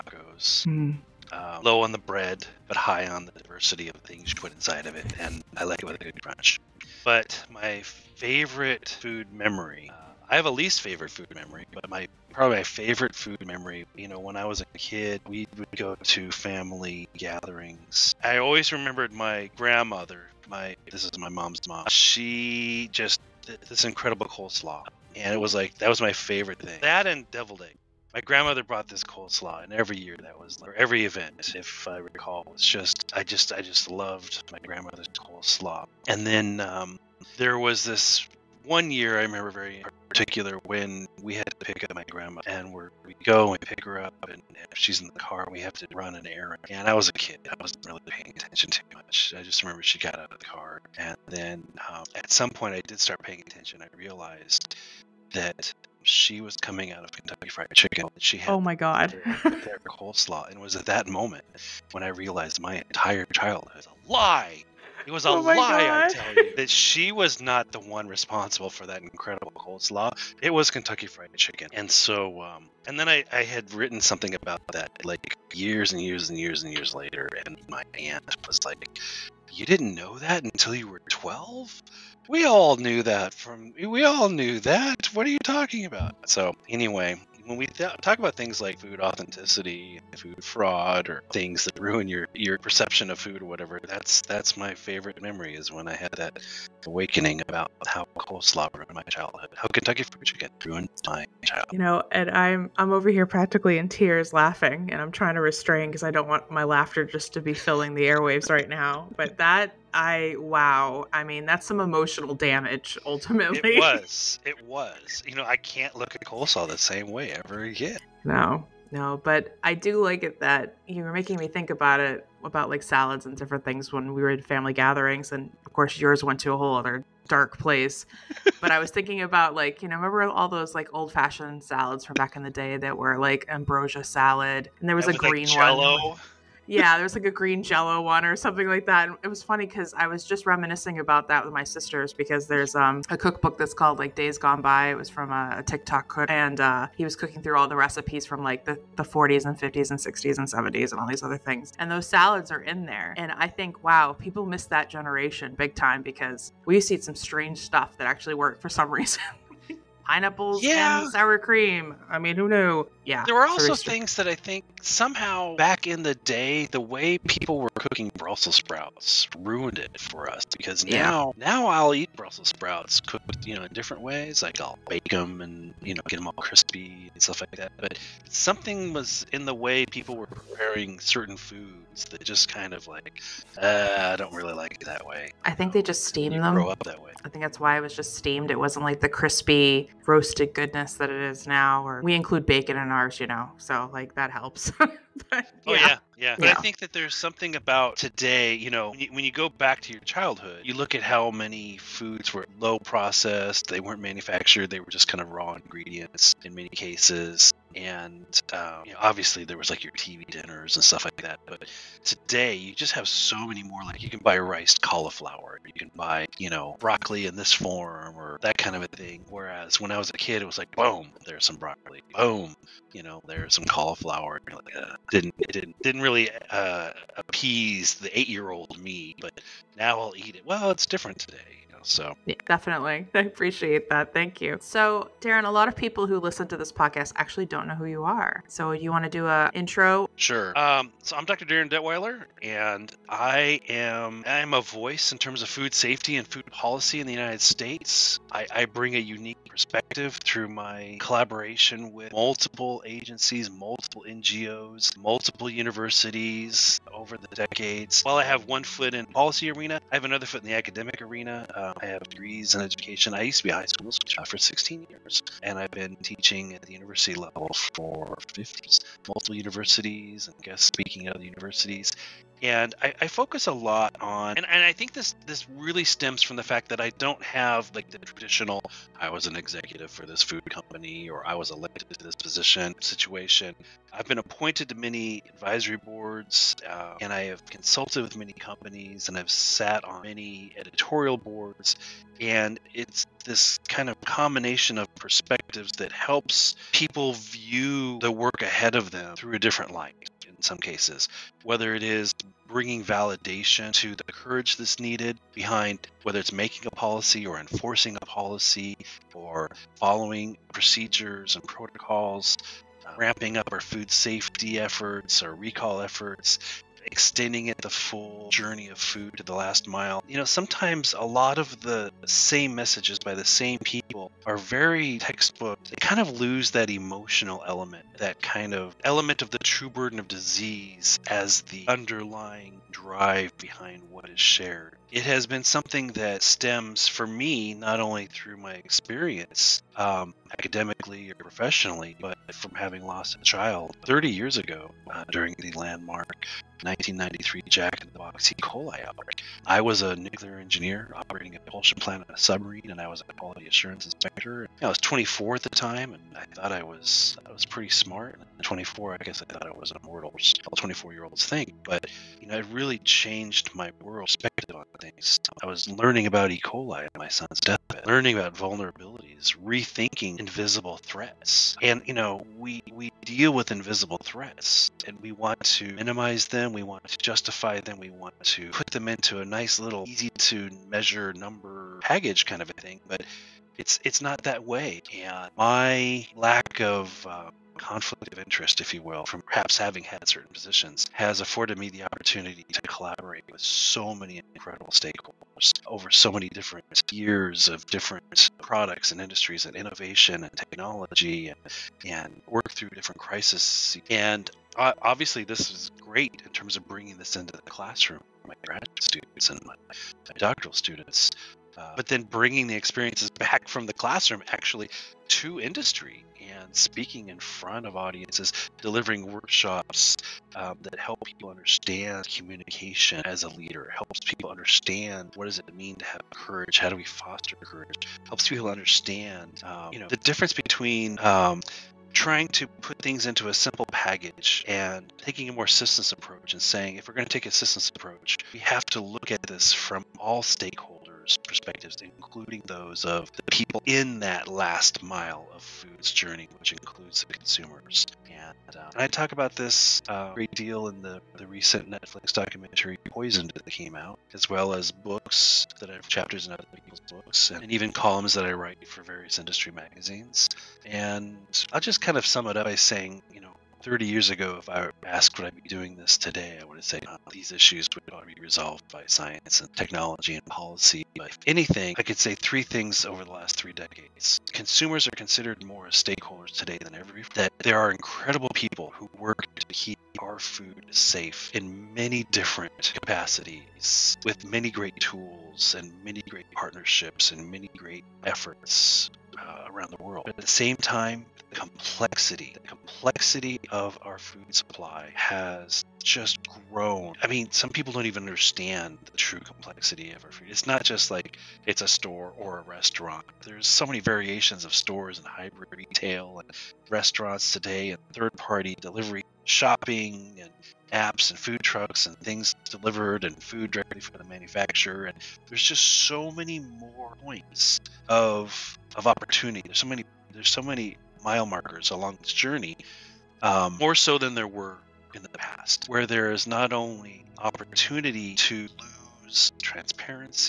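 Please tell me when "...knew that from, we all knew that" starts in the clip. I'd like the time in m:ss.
1:22.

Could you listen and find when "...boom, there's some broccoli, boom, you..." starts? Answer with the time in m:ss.
3:40.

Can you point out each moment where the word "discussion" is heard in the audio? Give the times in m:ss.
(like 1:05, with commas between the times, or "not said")
not said.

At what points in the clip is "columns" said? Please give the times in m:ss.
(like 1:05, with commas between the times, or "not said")
7:37.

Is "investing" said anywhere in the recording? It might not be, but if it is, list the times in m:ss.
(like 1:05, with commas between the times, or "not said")
not said.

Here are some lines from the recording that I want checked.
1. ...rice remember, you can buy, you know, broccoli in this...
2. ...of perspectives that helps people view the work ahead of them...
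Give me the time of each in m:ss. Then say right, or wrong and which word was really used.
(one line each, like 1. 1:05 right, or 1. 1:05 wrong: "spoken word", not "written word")
1. 3:34 wrong: "cauliflower", not "remember"
2. 4:54 right.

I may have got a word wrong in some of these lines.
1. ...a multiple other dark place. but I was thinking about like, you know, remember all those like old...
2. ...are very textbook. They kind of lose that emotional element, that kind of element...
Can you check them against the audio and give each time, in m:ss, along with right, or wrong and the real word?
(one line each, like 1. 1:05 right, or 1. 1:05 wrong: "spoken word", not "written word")
1. 2:06 wrong: "whole", not "multiple"
2. 5:24 right.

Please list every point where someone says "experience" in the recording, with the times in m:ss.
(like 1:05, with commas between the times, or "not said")
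5:38, 6:52.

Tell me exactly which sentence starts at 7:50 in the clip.
But if anything, I could say three things over the last three decades.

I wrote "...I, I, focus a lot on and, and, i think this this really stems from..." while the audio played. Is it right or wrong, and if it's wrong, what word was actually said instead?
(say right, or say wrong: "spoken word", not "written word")
right.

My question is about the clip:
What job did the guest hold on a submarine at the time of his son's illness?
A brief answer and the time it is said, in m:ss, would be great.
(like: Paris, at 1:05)
Nuclear engineer, at 5:49.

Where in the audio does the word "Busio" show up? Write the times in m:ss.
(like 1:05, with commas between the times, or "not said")
not said.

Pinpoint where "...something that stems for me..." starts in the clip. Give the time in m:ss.
5:35.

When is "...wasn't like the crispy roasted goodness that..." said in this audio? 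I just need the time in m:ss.
3:08.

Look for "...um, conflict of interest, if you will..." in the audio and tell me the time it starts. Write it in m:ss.
6:27.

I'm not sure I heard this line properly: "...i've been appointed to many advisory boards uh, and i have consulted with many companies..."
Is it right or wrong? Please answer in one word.
right.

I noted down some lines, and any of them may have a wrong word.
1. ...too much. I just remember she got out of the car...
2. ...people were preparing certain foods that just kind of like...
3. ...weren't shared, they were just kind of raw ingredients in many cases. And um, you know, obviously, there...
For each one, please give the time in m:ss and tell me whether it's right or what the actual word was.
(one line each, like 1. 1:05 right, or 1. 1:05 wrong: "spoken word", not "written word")
1. 0:48 right
2. 2:59 right
3. 3:23 wrong: "manufactured", not "shared".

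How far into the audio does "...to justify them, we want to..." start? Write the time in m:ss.
6:16.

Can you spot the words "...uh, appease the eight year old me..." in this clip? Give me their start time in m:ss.
3:46.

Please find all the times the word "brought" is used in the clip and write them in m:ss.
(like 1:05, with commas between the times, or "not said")
0:28.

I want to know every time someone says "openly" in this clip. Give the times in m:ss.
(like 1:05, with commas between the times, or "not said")
not said.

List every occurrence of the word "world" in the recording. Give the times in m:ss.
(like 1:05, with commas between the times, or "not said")
6:03, 8:09.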